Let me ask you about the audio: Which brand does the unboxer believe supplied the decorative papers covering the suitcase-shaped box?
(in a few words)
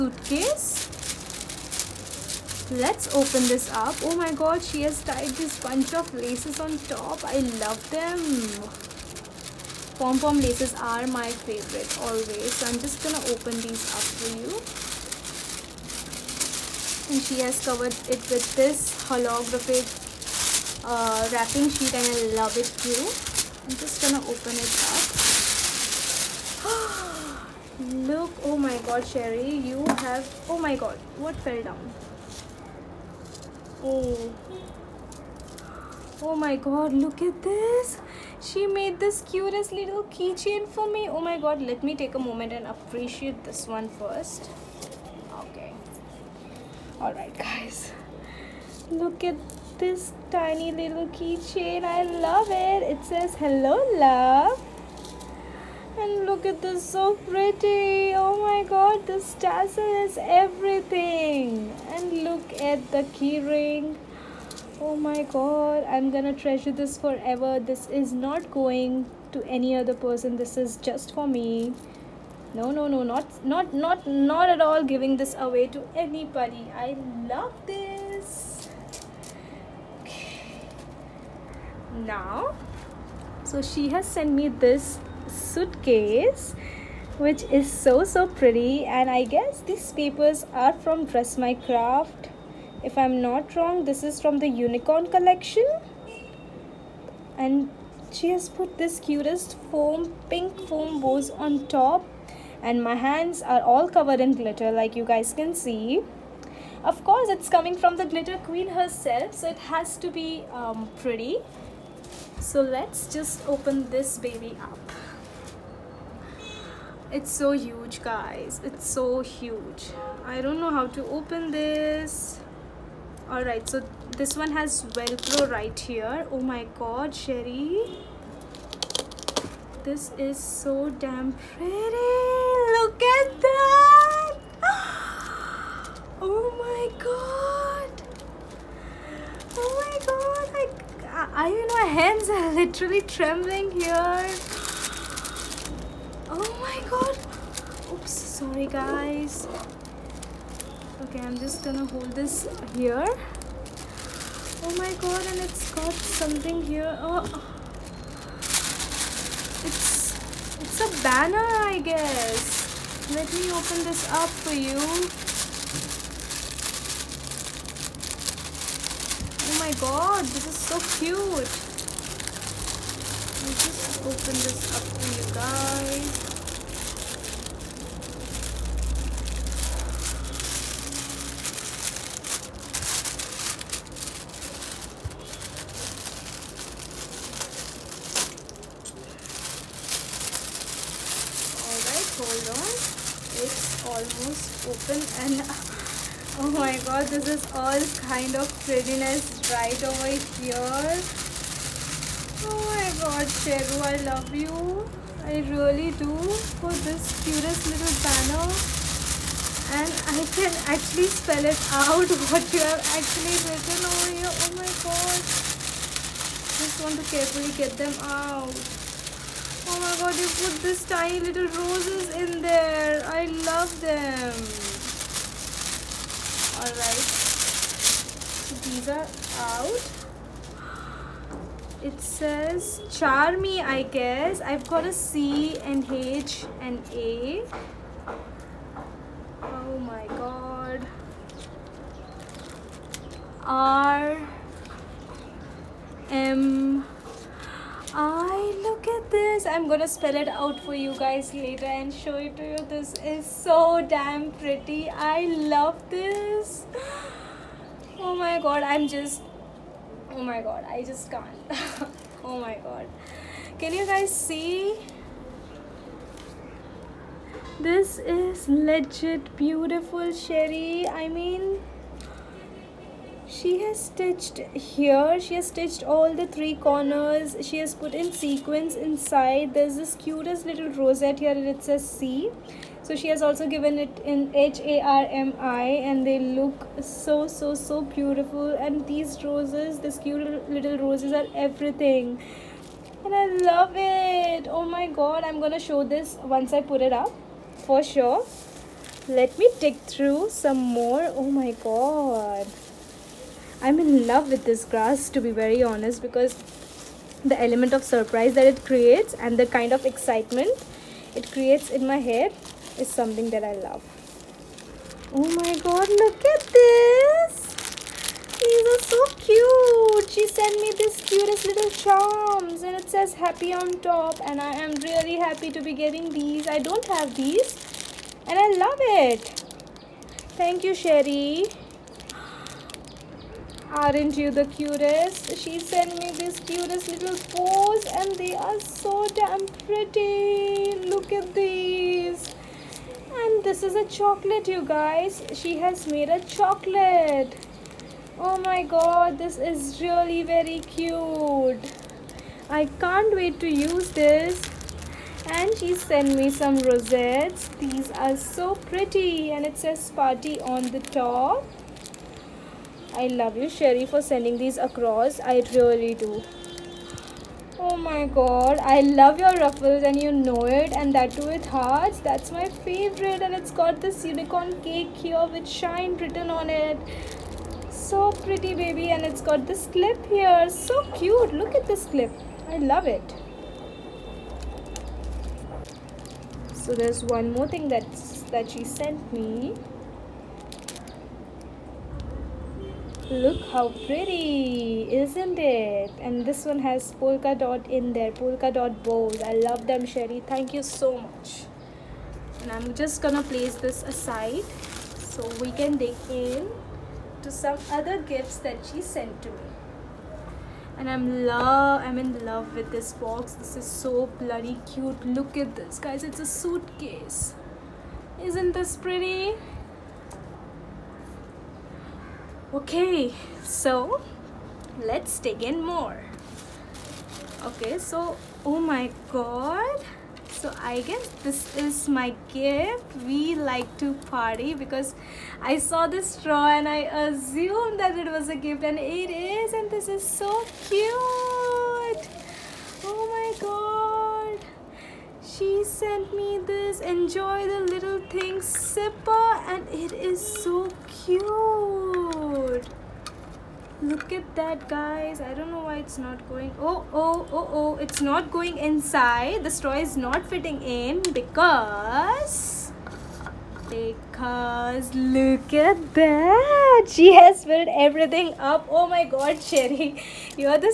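Dress My Craft.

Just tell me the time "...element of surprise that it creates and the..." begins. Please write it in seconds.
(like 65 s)
307 s.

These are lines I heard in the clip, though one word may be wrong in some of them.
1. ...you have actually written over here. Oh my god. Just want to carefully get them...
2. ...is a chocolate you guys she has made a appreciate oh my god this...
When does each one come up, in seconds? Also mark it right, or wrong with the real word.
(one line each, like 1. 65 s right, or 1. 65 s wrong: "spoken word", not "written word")
1. 212 s right
2. 343 s wrong: "chocolate", not "appreciate".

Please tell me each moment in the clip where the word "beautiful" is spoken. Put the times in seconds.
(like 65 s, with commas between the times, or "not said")
269 s, 287 s.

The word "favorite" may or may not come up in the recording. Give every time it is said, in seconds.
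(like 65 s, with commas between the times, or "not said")
11 s, 372 s.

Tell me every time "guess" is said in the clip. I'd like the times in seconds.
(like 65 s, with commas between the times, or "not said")
89 s, 161 s, 233 s, 430 s.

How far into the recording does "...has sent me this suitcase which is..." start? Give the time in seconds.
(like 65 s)
83 s.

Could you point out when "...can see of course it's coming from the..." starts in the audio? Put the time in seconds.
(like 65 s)
105 s.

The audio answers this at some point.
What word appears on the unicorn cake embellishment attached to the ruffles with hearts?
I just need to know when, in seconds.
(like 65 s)
375 s.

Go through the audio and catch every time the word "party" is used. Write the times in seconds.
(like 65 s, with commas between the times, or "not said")
360 s, 434 s.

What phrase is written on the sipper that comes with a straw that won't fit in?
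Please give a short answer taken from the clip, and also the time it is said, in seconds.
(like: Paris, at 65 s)
enjoy the little thing, at 446 s.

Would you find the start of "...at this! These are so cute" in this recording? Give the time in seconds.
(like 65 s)
316 s.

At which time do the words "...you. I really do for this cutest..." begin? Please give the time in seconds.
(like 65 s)
204 s.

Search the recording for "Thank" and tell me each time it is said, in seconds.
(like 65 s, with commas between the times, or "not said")
330 s, 400 s.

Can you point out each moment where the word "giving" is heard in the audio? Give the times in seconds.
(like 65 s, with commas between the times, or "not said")
74 s.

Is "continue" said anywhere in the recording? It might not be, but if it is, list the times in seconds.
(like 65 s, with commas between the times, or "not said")
not said.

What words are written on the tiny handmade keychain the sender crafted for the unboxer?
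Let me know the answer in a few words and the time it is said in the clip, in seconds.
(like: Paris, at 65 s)
hello love, at 53 s.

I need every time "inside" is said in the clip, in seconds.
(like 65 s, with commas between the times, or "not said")
278 s, 458 s.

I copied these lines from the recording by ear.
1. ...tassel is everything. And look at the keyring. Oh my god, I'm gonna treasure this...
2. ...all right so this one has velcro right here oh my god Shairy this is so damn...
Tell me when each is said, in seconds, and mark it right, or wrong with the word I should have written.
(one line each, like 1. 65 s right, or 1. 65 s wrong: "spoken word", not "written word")
1. 59 s right
2. 123 s right.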